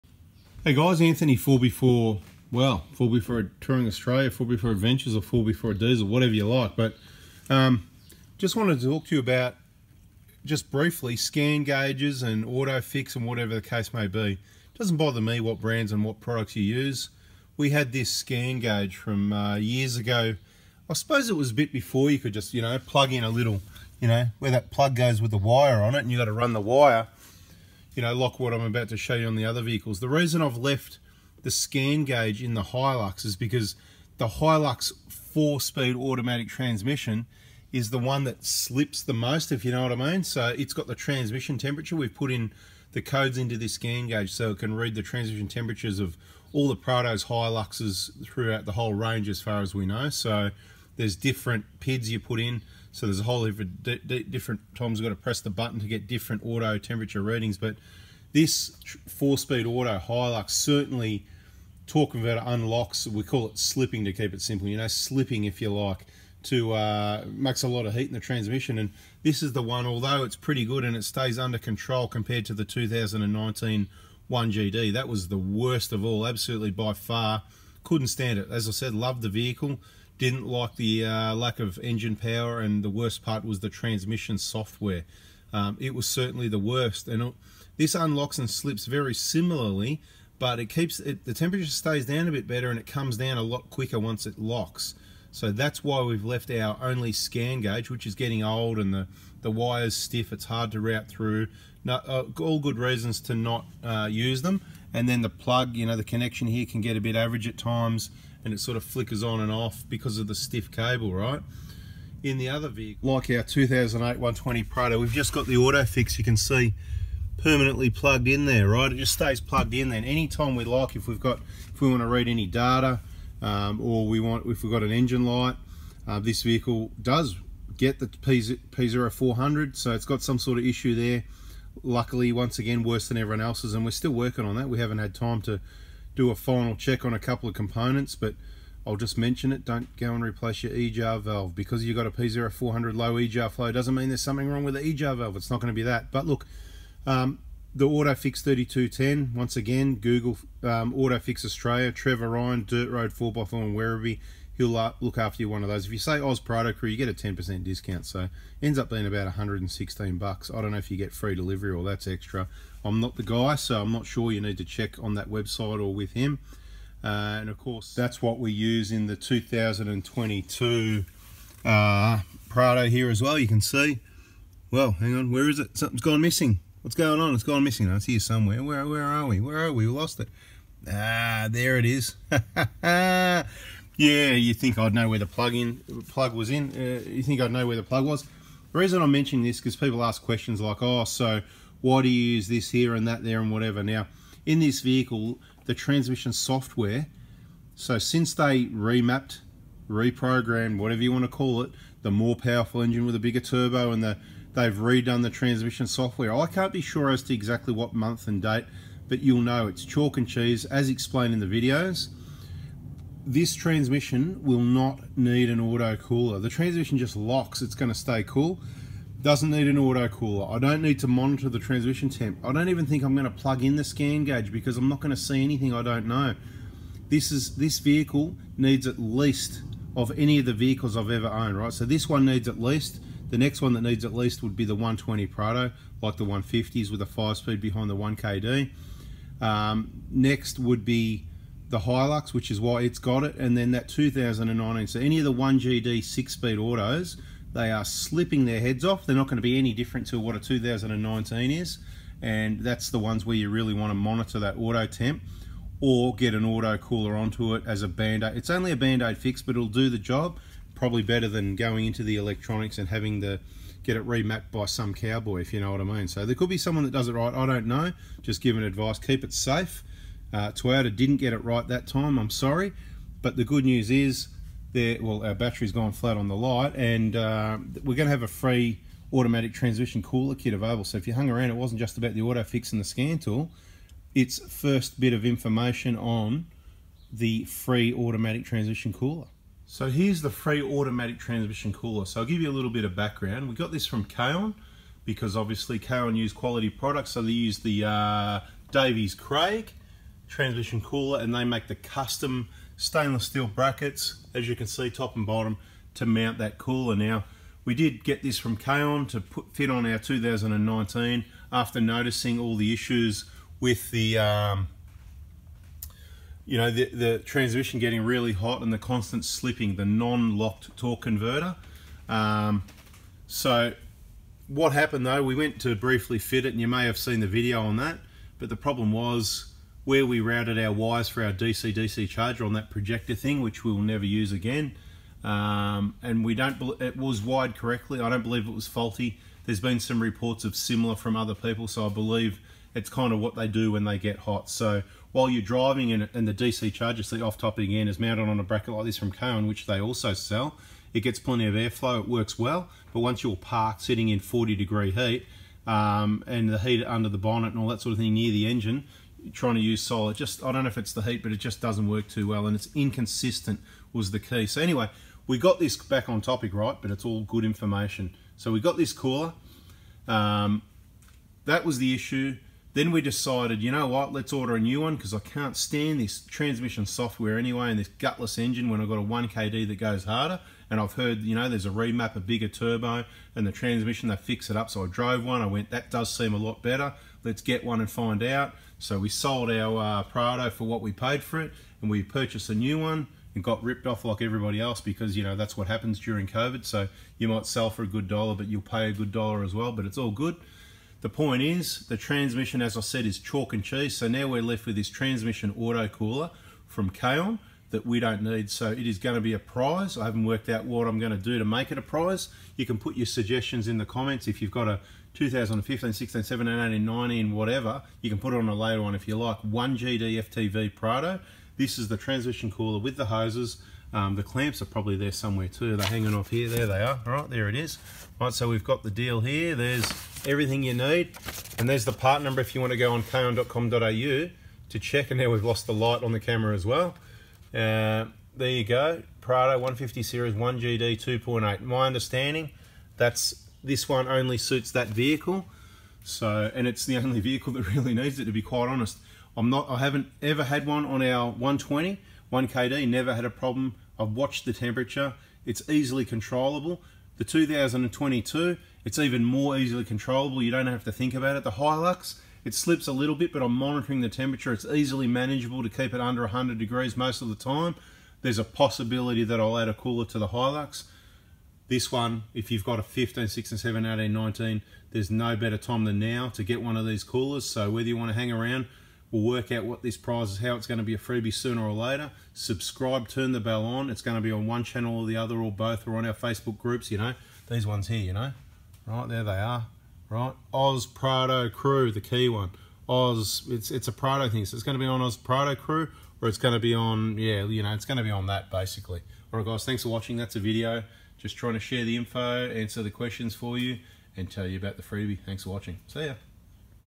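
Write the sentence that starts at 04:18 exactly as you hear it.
It's only a band-aid fix, but it'll do the job.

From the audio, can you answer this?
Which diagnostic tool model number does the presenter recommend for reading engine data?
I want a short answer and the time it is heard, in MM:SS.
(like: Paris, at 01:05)
3210, at 02:28.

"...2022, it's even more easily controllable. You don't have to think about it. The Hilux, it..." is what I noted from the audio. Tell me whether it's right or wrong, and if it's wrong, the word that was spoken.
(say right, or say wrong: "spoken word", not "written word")
right.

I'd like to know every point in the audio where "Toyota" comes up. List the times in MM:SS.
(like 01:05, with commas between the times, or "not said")
04:30.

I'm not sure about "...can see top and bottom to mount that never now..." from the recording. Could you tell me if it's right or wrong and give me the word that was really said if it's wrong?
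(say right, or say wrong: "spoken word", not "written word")
wrong: "cooler", not "never".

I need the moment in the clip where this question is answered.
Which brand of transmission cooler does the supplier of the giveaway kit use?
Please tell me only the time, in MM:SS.
04:58.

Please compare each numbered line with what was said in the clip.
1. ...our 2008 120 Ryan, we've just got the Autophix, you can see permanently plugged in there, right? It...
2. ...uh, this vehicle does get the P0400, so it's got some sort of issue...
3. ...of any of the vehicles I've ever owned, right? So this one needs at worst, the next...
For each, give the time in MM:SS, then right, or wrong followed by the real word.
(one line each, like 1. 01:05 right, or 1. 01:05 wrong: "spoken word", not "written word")
1. 01:53 wrong: "Prado", not "Ryan"
2. 02:06 right
3. 03:49 wrong: "least", not "worst".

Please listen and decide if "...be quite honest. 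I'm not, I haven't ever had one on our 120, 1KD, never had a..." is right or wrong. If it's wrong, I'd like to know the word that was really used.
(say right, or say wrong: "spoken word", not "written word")
right.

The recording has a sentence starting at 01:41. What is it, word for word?
uh, all good reasons to not uh, use them.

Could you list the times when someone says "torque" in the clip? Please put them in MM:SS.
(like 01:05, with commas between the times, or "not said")
01:01, 05:20.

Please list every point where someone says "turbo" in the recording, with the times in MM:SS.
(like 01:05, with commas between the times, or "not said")
03:23, 06:22.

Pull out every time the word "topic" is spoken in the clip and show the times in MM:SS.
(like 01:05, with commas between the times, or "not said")
05:47, 06:06.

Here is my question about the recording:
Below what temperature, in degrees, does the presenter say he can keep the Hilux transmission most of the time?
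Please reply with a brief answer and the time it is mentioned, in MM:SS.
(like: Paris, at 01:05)
100, at 07:46.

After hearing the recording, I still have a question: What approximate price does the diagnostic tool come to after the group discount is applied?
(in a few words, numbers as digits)
116 bucks.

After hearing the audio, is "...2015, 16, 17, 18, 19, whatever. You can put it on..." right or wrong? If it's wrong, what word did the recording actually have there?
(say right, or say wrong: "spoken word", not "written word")
right.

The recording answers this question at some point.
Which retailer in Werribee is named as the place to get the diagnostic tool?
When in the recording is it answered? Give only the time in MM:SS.
02:32.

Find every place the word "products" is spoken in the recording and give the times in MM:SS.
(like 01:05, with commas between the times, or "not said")
00:16, 04:56.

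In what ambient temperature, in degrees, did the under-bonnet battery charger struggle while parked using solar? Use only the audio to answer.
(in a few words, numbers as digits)
40.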